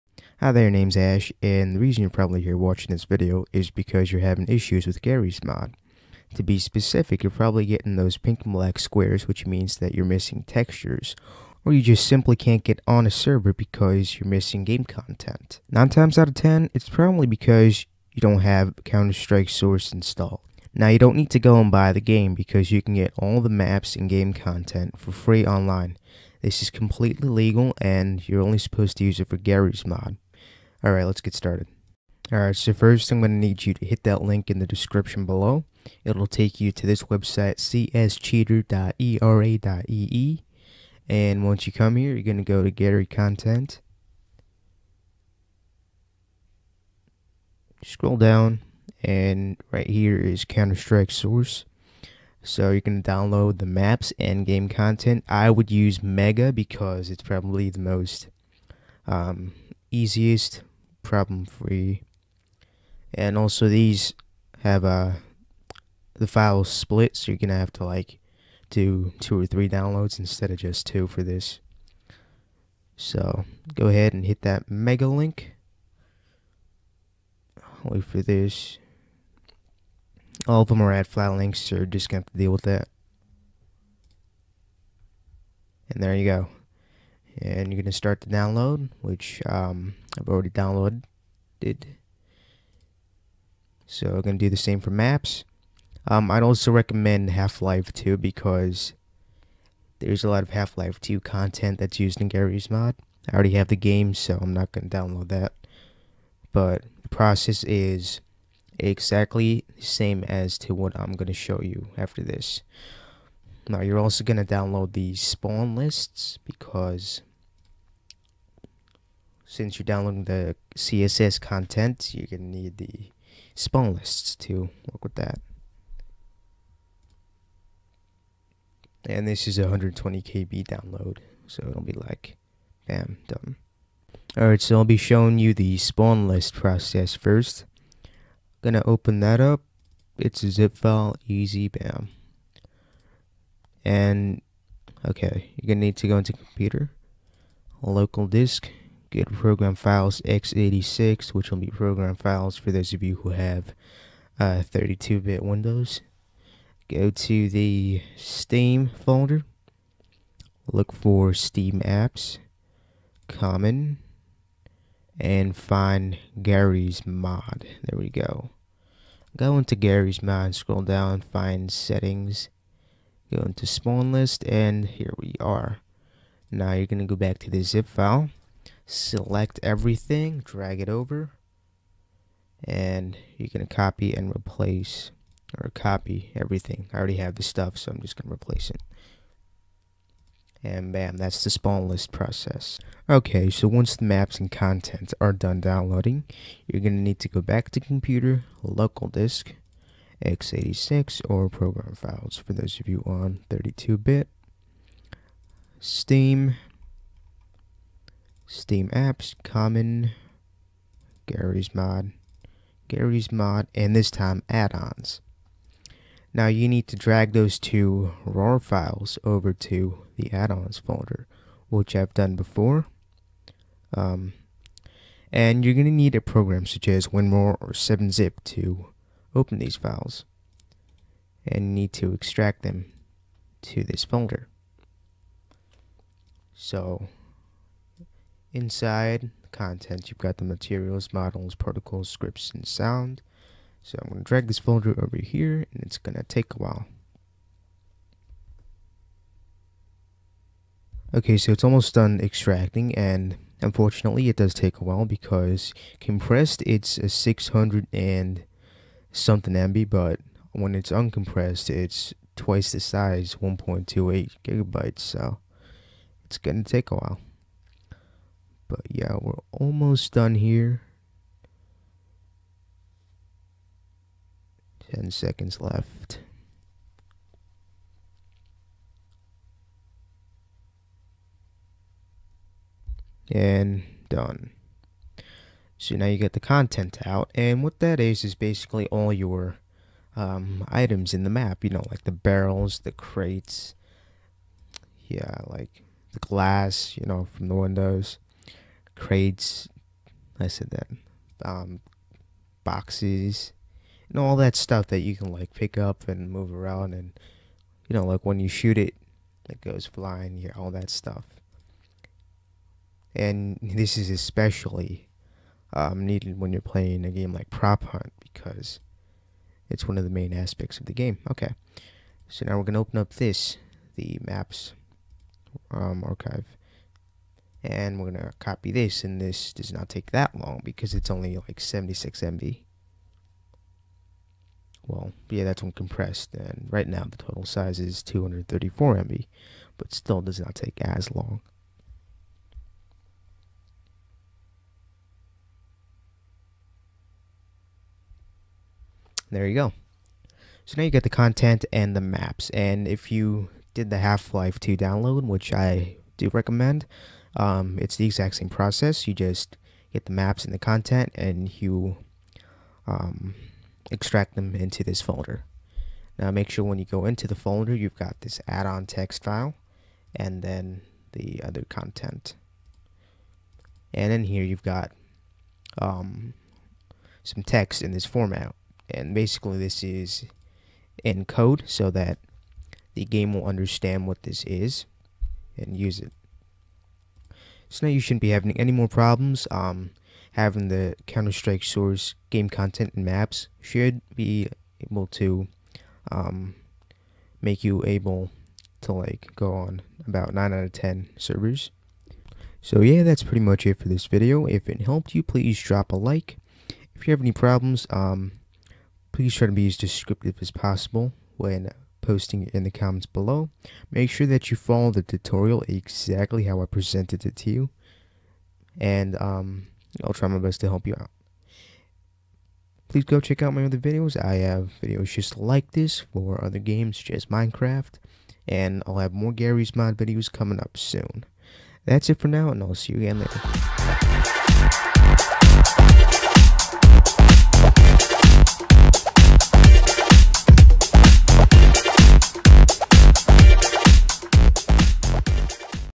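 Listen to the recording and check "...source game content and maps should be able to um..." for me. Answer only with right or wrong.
right.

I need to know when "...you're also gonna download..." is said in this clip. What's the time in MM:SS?
01:53.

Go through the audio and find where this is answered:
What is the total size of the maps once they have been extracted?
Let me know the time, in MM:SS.
05:38.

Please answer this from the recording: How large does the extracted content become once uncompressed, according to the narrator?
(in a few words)
1.28 gigabytes.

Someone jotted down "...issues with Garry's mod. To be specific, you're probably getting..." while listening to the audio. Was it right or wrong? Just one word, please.
right.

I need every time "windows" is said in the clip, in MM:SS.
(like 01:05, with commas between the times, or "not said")
02:35, 04:57.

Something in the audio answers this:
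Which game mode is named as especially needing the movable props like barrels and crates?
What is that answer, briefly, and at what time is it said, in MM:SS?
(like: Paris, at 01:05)
Prop Hunt, at 05:17.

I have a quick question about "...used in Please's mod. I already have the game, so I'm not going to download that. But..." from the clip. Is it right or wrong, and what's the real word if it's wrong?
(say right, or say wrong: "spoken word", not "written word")
wrong: "Garry", not "Please".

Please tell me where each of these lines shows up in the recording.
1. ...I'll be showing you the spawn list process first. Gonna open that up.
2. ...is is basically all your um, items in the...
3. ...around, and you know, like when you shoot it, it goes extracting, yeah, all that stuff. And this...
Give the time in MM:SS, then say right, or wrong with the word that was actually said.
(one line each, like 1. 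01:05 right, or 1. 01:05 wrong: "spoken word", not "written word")
1. 02:14 right
2. 04:47 right
3. 05:06 wrong: "flying", not "extracting".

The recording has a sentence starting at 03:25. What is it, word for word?
Steam, Steam apps, common, Garry's mod, Garry's mod, and this time add-ons.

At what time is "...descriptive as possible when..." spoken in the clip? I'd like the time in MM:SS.
06:49.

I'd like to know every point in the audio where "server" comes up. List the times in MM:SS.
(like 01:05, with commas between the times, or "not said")
00:13, 06:41.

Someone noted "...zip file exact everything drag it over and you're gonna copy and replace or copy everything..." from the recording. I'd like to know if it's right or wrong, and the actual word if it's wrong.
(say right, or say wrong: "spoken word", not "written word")
wrong: "select", not "exact".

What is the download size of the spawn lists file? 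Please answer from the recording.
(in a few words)
120 KB.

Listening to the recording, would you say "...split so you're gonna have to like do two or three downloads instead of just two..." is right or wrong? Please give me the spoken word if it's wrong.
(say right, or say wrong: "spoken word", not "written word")
right.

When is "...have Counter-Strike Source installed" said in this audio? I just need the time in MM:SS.
00:18.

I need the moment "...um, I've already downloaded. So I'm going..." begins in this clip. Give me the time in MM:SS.
01:29.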